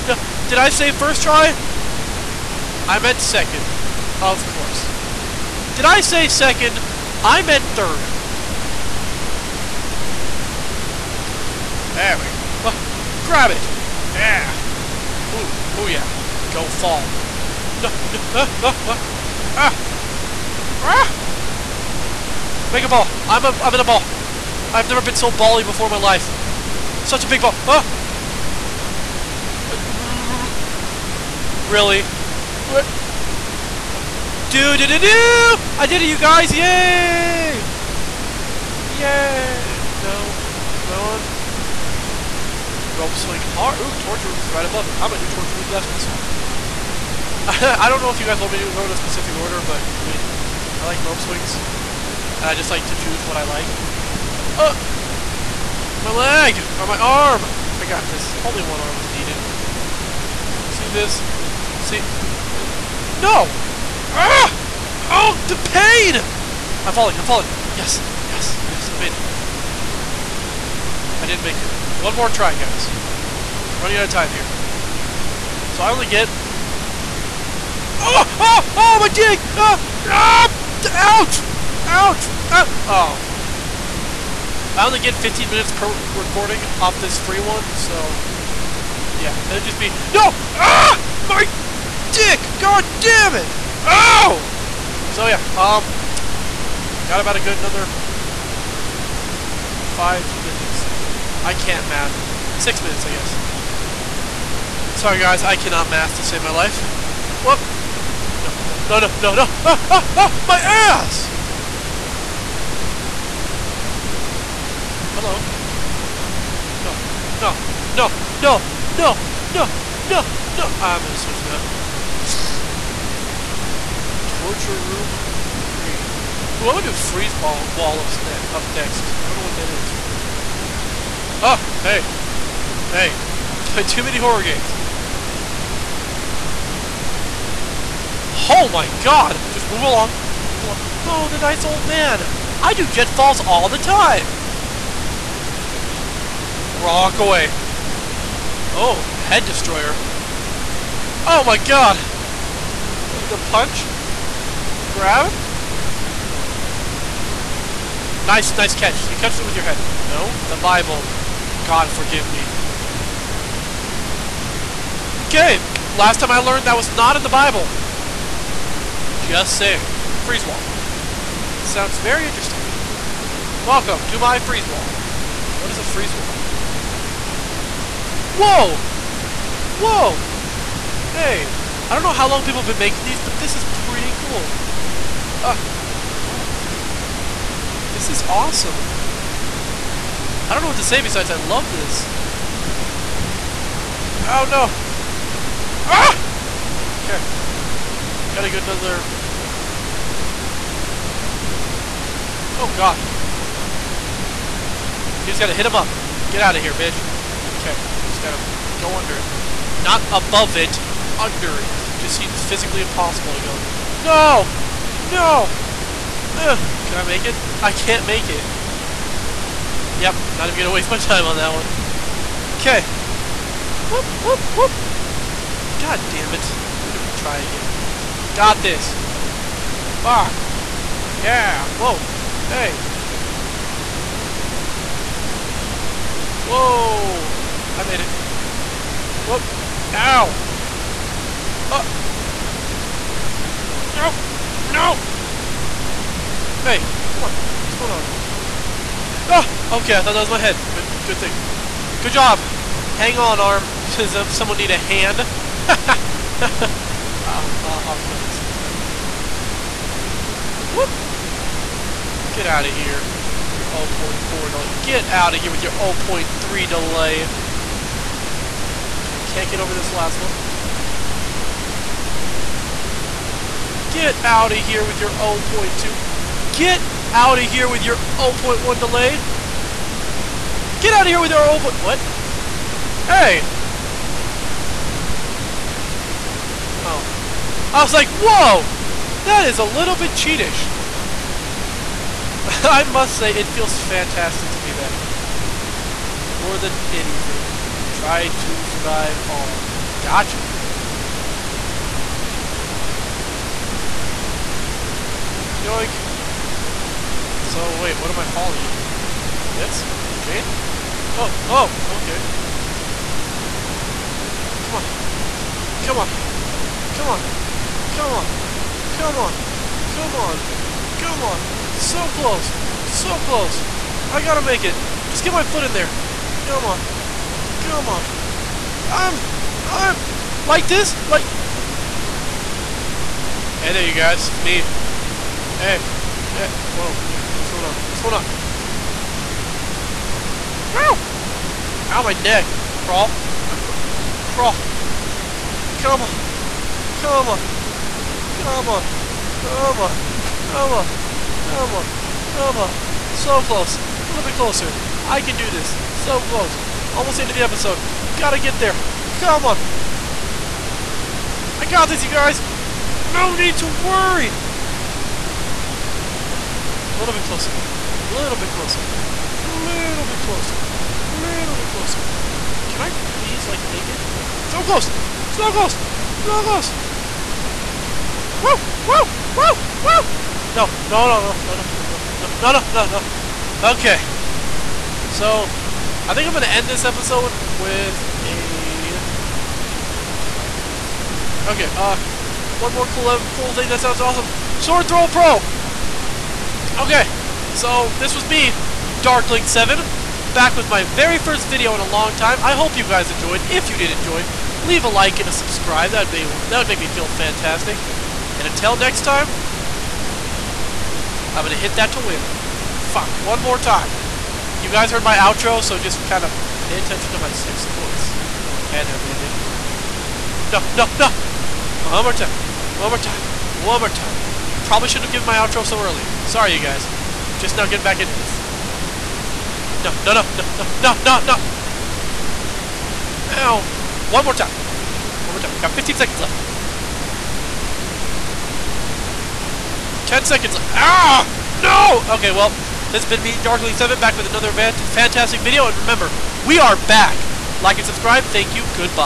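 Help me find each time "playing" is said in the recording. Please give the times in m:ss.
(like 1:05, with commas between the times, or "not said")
2:13.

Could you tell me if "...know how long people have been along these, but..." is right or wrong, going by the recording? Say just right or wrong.
wrong.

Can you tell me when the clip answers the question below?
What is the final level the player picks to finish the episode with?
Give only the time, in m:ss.
6:34.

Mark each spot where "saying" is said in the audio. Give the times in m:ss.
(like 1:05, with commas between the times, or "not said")
2:49.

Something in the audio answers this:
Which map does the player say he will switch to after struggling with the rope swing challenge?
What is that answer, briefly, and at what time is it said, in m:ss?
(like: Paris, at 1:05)
Torture Room 3, at 2:04.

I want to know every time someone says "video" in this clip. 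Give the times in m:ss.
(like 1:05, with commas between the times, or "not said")
6:41, 7:25.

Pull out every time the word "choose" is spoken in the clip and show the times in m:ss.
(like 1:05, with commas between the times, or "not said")
0:52.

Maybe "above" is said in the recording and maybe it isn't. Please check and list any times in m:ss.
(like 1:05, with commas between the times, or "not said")
0:44, 3:30.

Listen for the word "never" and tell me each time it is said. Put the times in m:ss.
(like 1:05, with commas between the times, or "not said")
0:24.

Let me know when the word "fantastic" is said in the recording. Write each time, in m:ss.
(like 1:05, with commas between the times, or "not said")
4:53, 6:47, 7:24.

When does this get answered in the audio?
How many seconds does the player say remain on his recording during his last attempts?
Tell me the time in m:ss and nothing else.
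7:15.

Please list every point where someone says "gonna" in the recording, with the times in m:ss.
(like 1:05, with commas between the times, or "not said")
0:45, 2:01, 2:06, 3:40, 3:46, 6:51.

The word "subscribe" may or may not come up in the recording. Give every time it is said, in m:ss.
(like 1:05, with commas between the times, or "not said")
6:45, 7:27.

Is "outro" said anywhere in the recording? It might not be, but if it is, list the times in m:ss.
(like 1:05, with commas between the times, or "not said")
6:55, 7:05.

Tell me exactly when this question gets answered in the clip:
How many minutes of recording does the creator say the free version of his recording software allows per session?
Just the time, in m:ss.
1:25.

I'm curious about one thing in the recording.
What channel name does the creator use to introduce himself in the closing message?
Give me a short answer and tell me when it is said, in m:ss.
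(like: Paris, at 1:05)
Darkling7, at 6:38.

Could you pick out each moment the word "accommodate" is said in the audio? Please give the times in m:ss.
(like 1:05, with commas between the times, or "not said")
not said.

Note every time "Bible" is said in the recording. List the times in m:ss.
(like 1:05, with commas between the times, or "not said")
2:40, 2:47.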